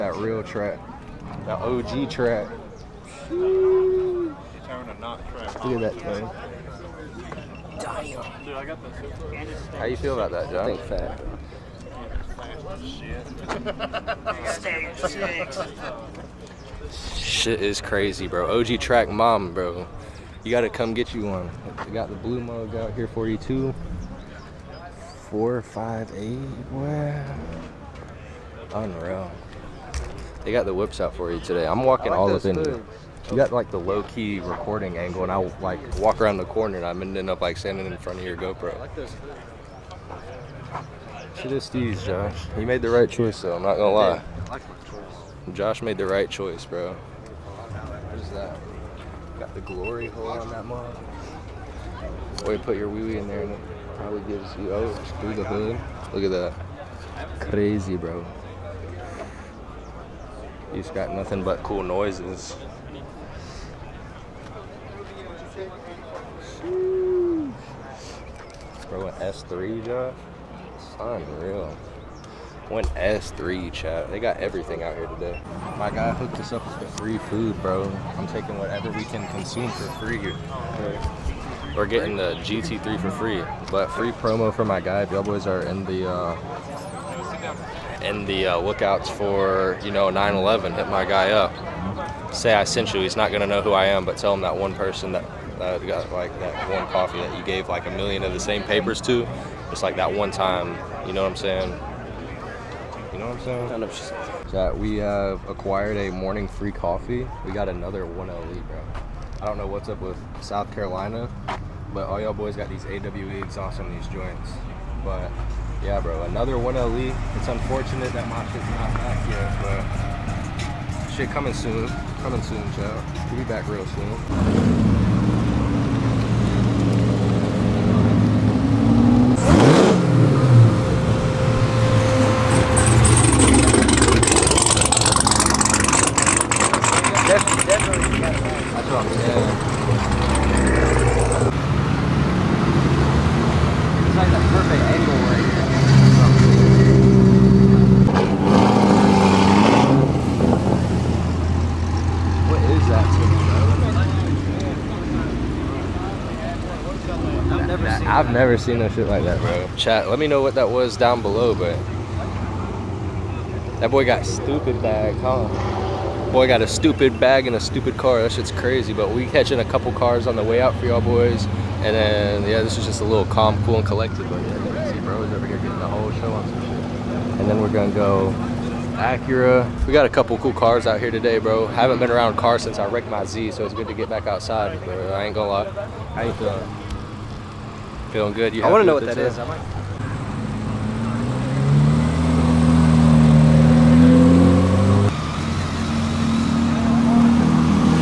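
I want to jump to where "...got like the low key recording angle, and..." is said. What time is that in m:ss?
0:33.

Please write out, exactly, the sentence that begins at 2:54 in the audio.
But yeah, can see bro over here getting the whole show on some shit.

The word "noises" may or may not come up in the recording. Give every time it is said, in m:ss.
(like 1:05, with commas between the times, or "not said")
1:01.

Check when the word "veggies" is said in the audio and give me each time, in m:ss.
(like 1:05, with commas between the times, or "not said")
not said.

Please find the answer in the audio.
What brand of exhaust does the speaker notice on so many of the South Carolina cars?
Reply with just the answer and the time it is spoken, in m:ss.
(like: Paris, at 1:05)
AWE, at 1:52.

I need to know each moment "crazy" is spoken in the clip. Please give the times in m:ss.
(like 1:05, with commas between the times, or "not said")
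0:17, 0:57, 2:48.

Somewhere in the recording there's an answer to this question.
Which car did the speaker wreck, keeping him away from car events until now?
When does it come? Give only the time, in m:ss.
3:03.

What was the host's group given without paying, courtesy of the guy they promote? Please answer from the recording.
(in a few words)
Food.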